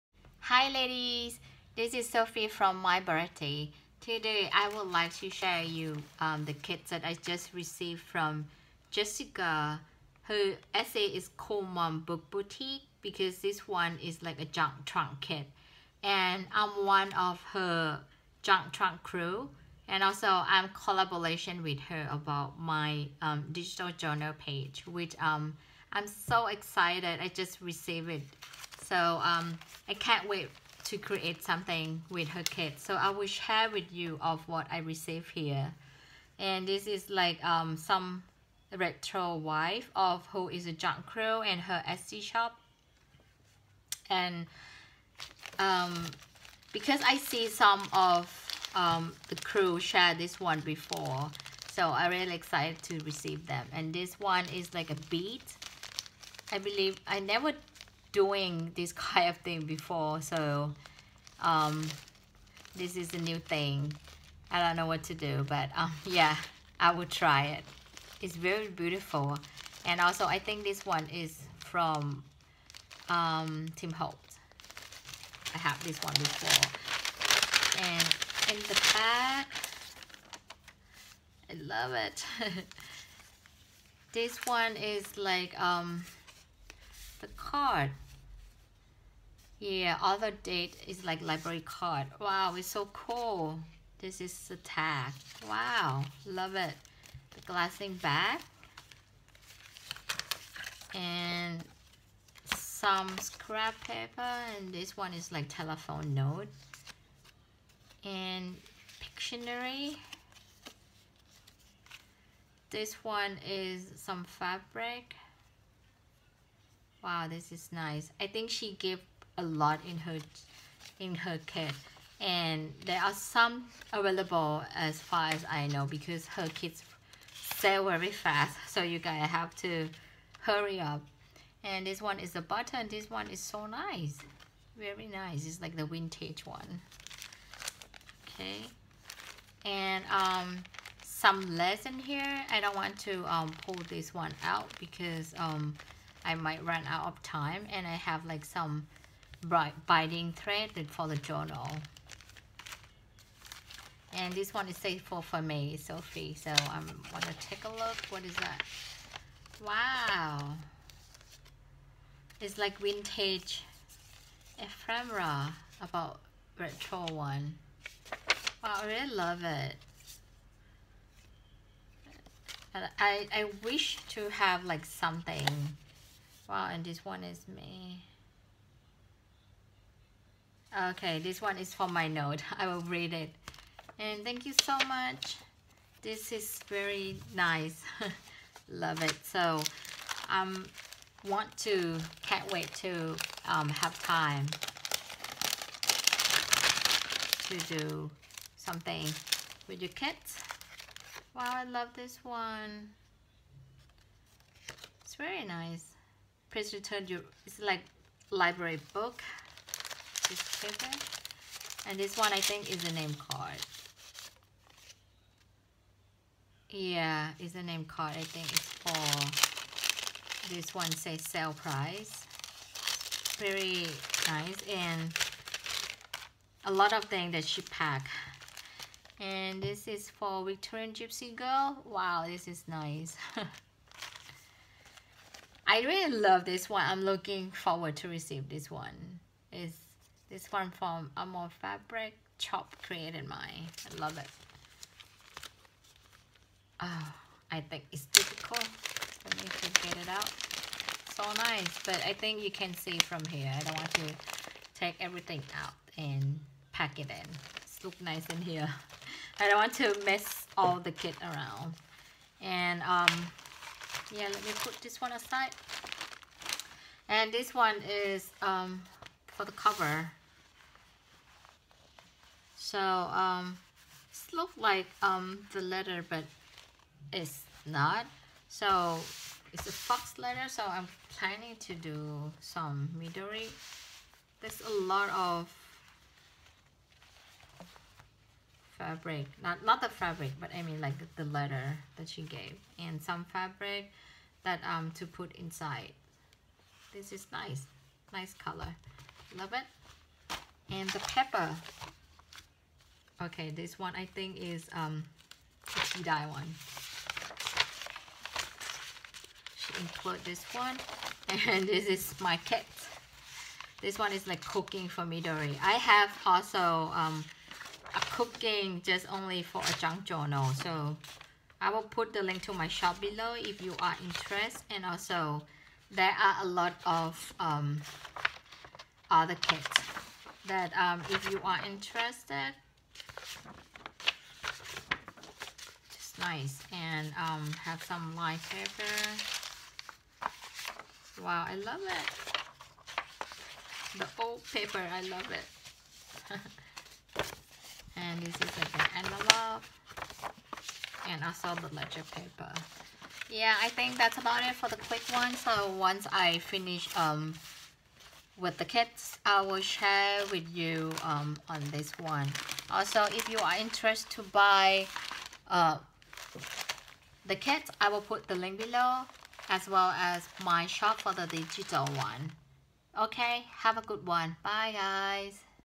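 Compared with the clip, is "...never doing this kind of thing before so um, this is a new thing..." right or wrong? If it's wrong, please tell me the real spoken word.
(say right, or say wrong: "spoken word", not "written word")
right.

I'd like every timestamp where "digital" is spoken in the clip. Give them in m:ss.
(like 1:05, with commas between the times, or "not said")
0:23, 6:11.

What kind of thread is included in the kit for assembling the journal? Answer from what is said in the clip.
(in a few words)
Binding thread.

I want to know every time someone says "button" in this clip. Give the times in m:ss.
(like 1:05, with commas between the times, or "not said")
2:12.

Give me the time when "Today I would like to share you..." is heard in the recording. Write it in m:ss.
0:04.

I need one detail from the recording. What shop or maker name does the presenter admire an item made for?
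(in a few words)
Victorian Gypsy Girl.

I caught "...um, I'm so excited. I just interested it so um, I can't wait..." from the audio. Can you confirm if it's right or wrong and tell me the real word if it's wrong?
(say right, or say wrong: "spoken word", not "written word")
wrong: "received", not "interested".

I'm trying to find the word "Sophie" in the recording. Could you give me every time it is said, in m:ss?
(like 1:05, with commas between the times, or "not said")
0:02, 2:35.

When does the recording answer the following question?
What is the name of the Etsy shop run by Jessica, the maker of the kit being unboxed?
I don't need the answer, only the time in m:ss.
0:11.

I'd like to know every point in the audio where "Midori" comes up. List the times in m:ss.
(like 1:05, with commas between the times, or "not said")
4:42, 5:15.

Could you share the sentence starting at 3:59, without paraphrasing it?
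It's this one from Amor Fabric Chop Created Mine.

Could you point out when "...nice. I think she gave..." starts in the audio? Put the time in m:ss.
1:57.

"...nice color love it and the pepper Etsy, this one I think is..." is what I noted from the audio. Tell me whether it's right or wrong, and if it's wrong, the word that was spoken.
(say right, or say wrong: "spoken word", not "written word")
wrong: "Okay", not "Etsy".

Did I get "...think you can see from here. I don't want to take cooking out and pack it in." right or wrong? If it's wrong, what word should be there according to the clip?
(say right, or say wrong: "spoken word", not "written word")
wrong: "everything", not "cooking".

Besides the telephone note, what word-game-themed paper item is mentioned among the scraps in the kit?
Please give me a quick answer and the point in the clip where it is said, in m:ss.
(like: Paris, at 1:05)
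Pictionary, at 1:48.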